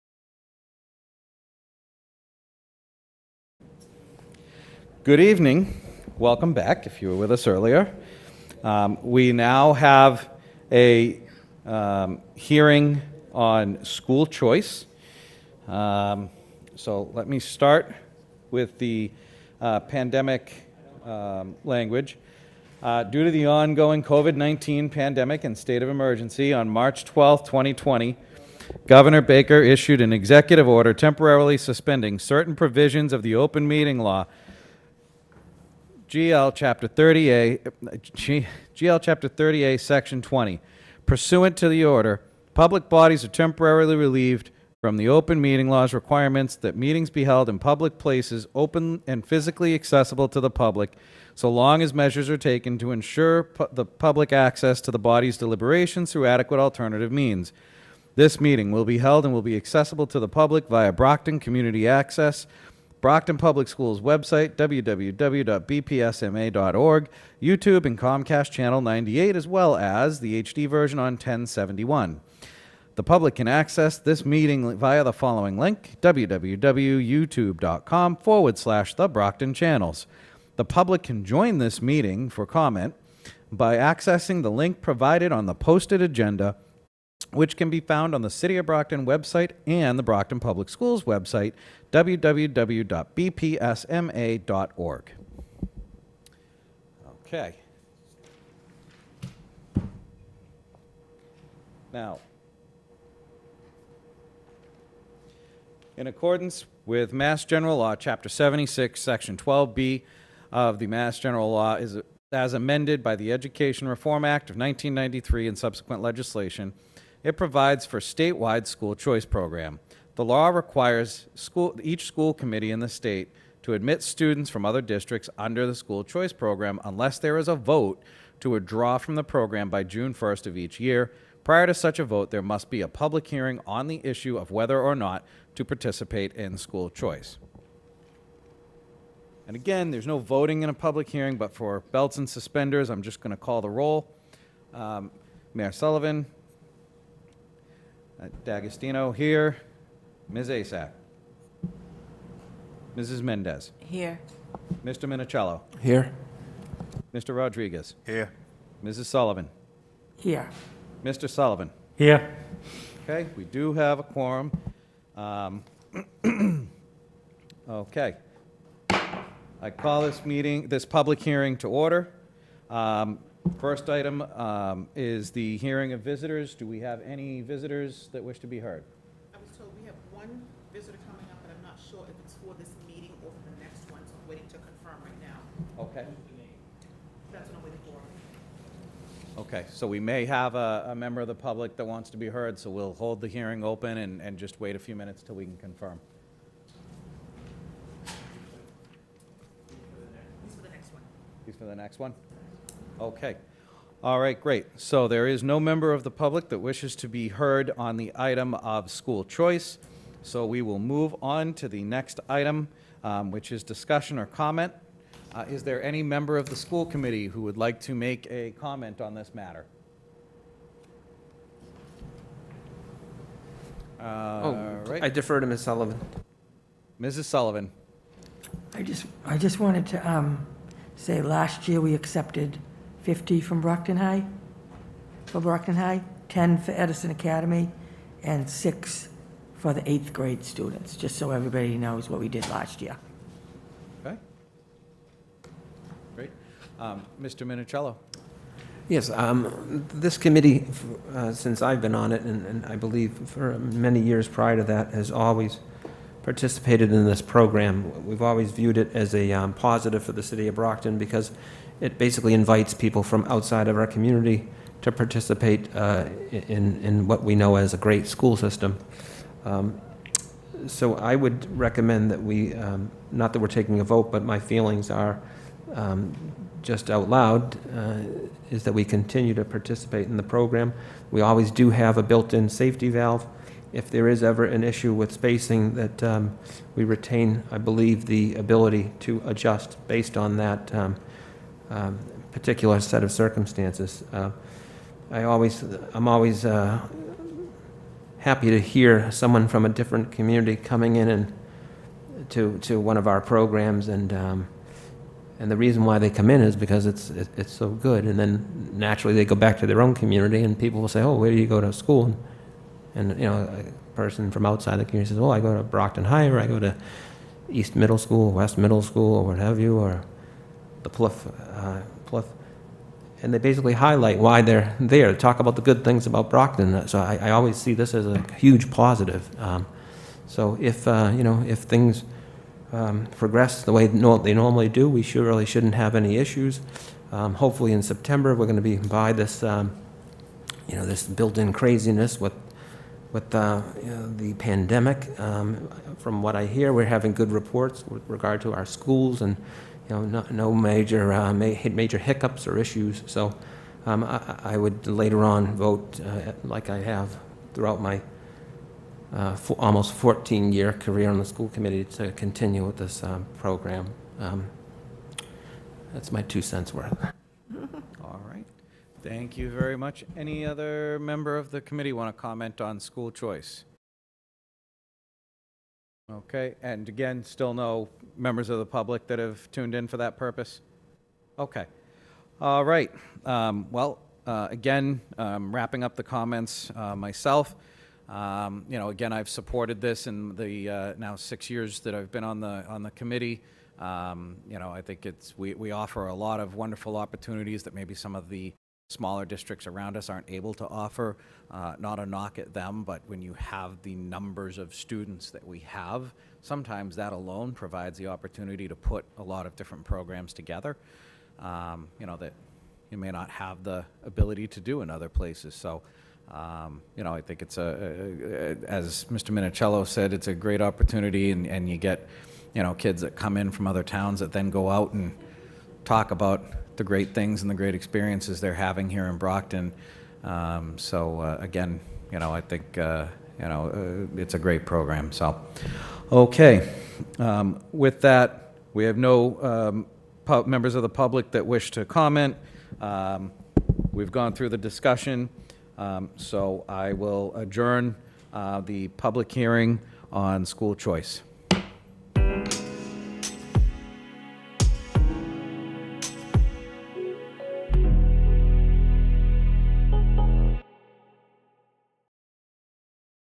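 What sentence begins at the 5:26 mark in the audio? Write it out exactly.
So I, I always see this as a huge positive.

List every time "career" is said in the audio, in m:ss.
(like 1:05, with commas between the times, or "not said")
6:00.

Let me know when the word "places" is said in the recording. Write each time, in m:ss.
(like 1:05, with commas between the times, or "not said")
0:47, 6:55.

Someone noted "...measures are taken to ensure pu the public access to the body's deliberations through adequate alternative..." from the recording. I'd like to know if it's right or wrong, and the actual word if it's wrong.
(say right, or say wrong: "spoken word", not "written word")
right.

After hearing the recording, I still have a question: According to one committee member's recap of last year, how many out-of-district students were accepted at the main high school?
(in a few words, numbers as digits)
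50.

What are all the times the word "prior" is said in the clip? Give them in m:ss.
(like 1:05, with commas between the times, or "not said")
2:11, 4:14.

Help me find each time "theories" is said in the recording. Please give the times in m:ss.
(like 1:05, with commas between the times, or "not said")
not said.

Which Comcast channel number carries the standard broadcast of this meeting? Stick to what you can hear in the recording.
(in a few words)
98.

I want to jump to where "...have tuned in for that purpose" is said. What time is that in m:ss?
6:19.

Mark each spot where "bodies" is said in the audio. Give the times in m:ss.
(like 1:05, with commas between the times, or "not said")
0:42.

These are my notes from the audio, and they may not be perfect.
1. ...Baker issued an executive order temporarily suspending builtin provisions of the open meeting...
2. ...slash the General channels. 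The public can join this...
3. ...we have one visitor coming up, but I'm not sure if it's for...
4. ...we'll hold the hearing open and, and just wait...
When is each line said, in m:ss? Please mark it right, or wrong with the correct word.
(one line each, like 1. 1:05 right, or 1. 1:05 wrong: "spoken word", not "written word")
1. 0:29 wrong: "certain", not "builtin"
2. 1:18 wrong: "Brockton", not "General"
3. 2:59 right
4. 3:12 right.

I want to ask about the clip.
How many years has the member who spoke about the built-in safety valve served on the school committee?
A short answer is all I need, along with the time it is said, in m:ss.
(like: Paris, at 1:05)
almost 14, at 5:59.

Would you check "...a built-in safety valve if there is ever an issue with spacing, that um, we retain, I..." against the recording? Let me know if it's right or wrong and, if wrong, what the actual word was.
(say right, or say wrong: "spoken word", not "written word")
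right.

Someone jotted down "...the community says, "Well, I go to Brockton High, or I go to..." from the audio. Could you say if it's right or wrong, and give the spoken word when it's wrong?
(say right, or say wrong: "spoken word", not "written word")
right.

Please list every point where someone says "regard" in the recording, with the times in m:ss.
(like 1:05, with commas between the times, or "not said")
5:48.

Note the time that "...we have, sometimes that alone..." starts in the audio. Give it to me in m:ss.
6:45.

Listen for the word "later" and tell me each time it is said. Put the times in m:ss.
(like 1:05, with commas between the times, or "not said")
5:54.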